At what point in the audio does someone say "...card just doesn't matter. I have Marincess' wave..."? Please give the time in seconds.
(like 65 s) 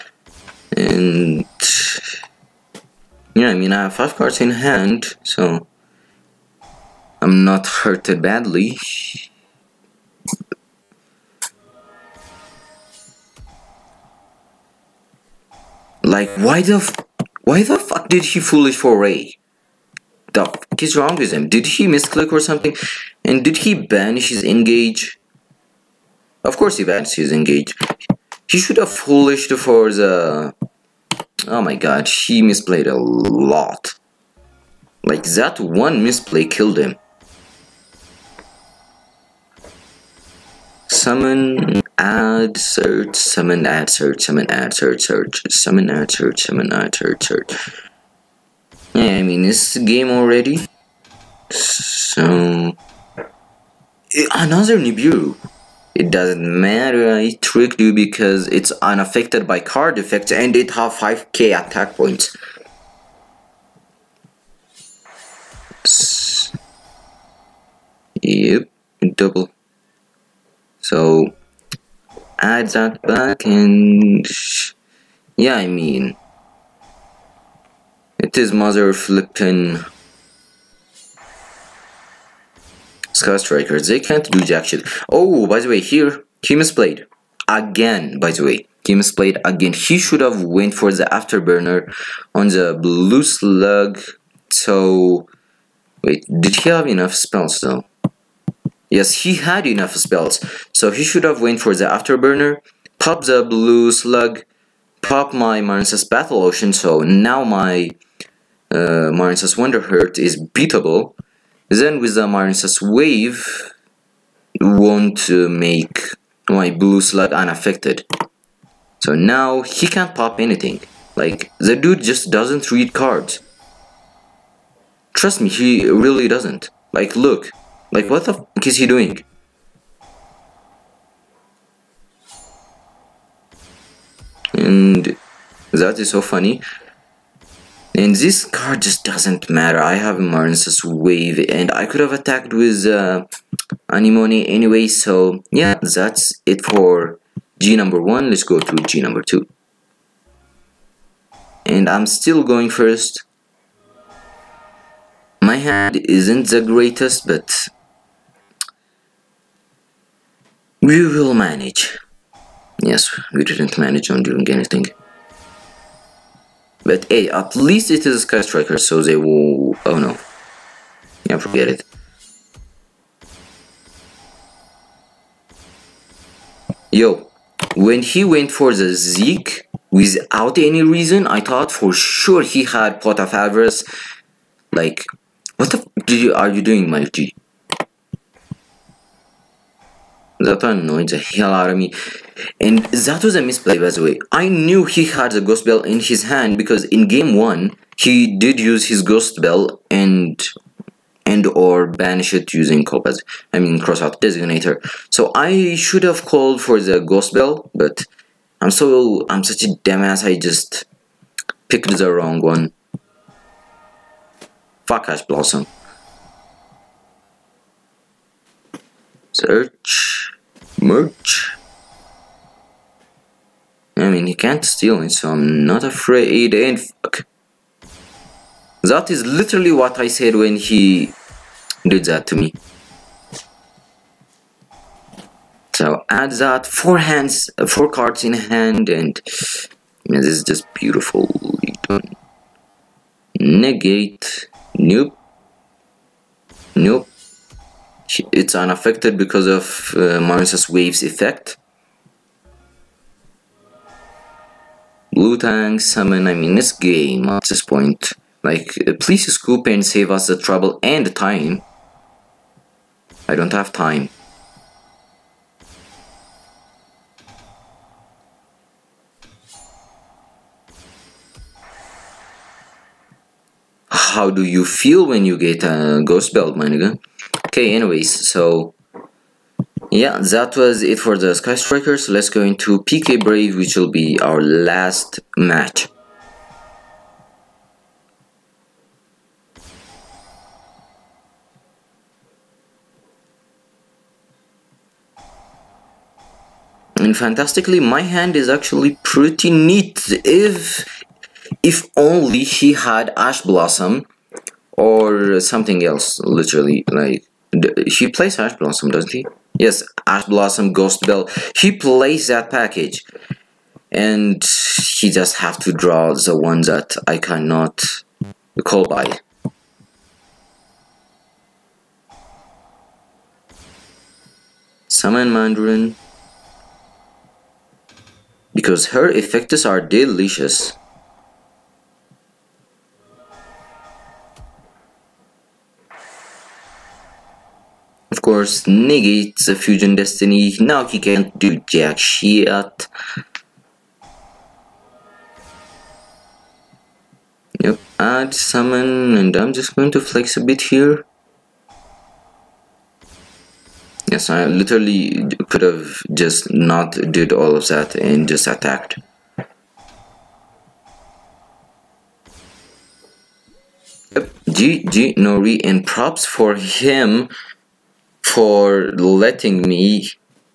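138 s.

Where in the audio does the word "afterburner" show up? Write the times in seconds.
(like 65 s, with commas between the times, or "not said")
91 s, 101 s.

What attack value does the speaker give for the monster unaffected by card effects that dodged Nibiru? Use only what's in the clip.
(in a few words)
5k.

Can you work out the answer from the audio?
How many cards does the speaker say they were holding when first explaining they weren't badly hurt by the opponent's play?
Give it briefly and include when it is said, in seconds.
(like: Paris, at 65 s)
5, at 3 s.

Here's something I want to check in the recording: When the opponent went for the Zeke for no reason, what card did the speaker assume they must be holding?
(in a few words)
Pot of Avarice.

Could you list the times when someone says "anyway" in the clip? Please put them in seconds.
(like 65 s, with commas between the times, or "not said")
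144 s, 277 s.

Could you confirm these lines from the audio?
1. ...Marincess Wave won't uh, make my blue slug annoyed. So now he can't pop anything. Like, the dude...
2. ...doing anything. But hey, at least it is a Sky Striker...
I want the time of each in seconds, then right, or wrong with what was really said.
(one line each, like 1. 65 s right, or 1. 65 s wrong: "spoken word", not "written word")
1. 112 s wrong: "unaffected", not "annoyed"
2. 164 s right.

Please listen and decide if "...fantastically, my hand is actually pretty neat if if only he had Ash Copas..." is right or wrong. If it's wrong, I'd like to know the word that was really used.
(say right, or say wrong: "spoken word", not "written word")
wrong: "Blossom", not "Copas".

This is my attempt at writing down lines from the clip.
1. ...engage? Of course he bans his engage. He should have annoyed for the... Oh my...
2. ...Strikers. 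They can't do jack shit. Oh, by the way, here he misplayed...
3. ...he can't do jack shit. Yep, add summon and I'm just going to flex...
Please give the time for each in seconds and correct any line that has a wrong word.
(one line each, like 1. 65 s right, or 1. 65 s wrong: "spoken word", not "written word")
1. 24 s wrong: "foolished", not "annoyed"
2. 83 s right
3. 340 s right.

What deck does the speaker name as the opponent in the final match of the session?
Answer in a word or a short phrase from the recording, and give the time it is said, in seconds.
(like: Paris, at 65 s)
PK Brave, at 282 s.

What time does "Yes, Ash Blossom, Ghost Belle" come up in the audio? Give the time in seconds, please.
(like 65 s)
309 s.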